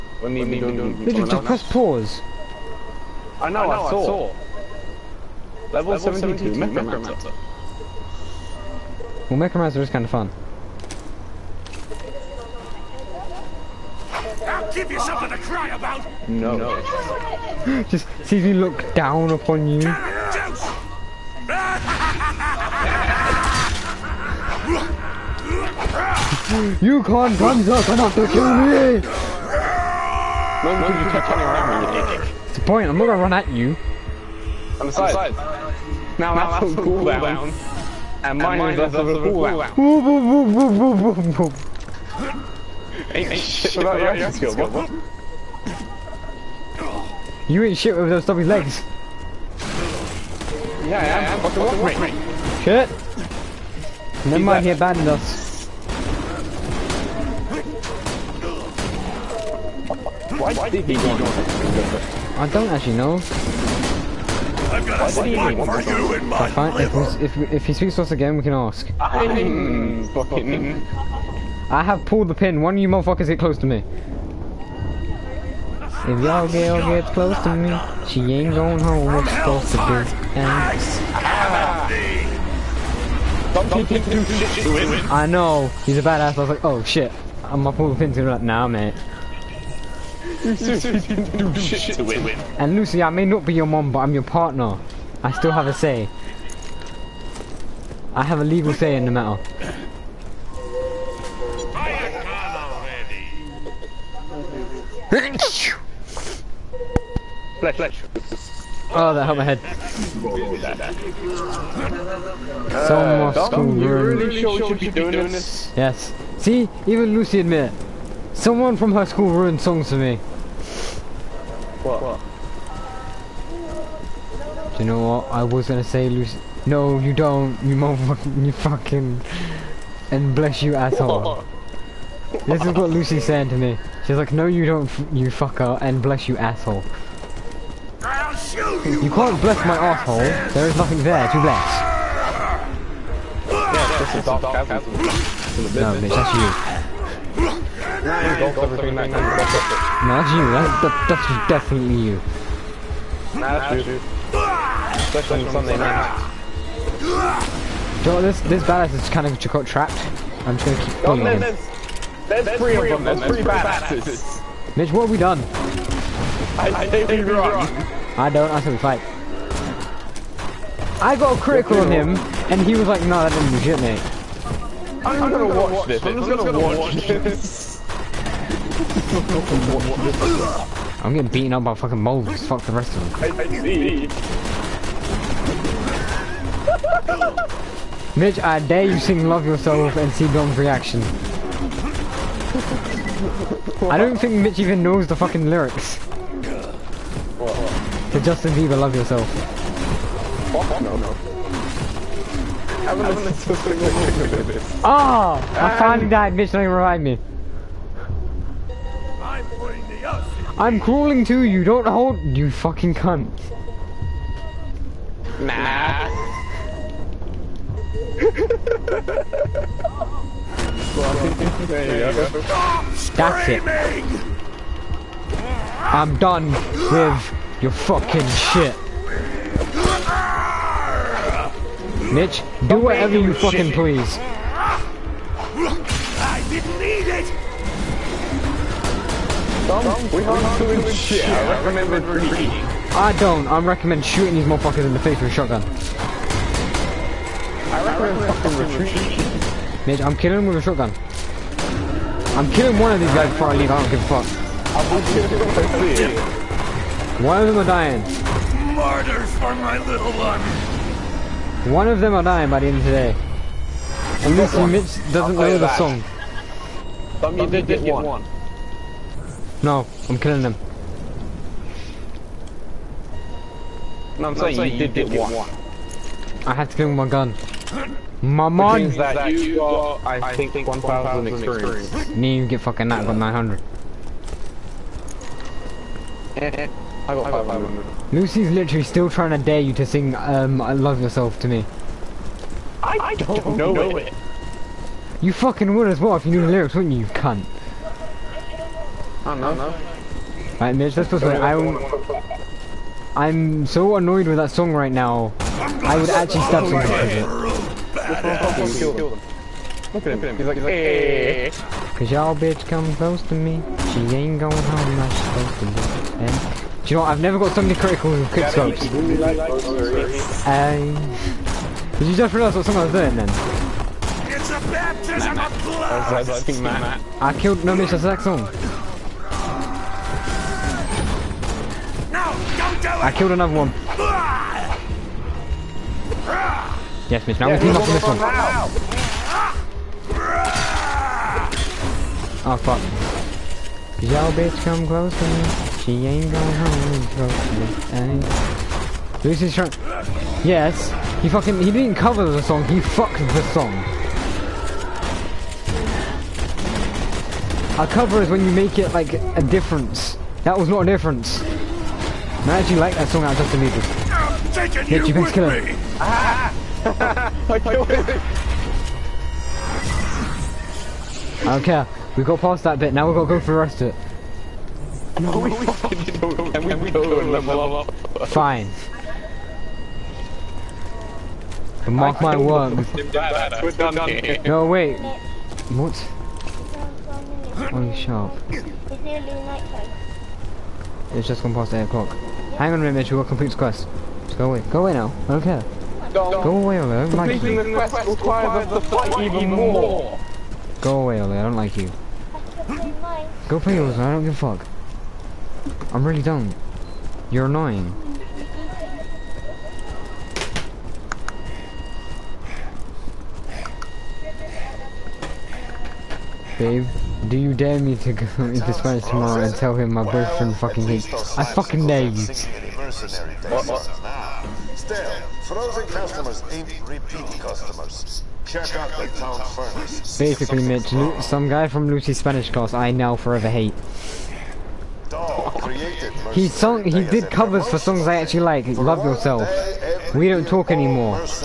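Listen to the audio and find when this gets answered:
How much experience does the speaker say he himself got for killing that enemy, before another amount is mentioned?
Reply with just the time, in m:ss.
4:43.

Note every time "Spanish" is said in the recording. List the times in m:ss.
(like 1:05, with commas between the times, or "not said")
6:58, 7:12.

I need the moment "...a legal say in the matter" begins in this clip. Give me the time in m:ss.
1:38.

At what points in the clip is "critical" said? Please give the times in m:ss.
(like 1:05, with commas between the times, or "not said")
2:51, 5:17.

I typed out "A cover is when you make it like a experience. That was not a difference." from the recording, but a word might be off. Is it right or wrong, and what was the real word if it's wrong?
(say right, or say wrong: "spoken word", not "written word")
wrong: "difference", not "experience".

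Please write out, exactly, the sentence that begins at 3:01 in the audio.
I'm getting beaten up by fucking moles.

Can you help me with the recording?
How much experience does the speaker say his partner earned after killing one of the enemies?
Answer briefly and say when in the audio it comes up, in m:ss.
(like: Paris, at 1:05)
1,000, at 4:40.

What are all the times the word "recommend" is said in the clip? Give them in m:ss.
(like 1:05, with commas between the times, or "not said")
4:03, 4:07.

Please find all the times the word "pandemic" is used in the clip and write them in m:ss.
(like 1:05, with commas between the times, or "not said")
not said.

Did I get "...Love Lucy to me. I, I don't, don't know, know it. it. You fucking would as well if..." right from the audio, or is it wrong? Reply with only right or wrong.
wrong.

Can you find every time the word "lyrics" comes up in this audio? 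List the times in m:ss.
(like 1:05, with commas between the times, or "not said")
3:15, 4:56.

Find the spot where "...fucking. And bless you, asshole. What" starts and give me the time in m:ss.
2:08.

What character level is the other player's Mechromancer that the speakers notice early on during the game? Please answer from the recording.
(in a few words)
72.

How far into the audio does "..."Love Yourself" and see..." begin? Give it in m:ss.
3:09.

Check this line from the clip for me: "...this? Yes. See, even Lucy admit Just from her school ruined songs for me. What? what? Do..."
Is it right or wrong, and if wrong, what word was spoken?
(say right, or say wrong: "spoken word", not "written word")
wrong: "Someone", not "Just".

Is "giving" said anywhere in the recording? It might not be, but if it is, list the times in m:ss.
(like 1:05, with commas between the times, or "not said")
not said.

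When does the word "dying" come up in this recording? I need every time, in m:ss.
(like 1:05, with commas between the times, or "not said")
4:17, 4:22.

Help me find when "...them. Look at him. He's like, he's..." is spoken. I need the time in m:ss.
5:09.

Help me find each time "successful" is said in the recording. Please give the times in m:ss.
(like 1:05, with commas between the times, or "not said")
not said.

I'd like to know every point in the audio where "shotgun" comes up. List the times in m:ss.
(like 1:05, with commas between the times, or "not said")
4:05, 4:10.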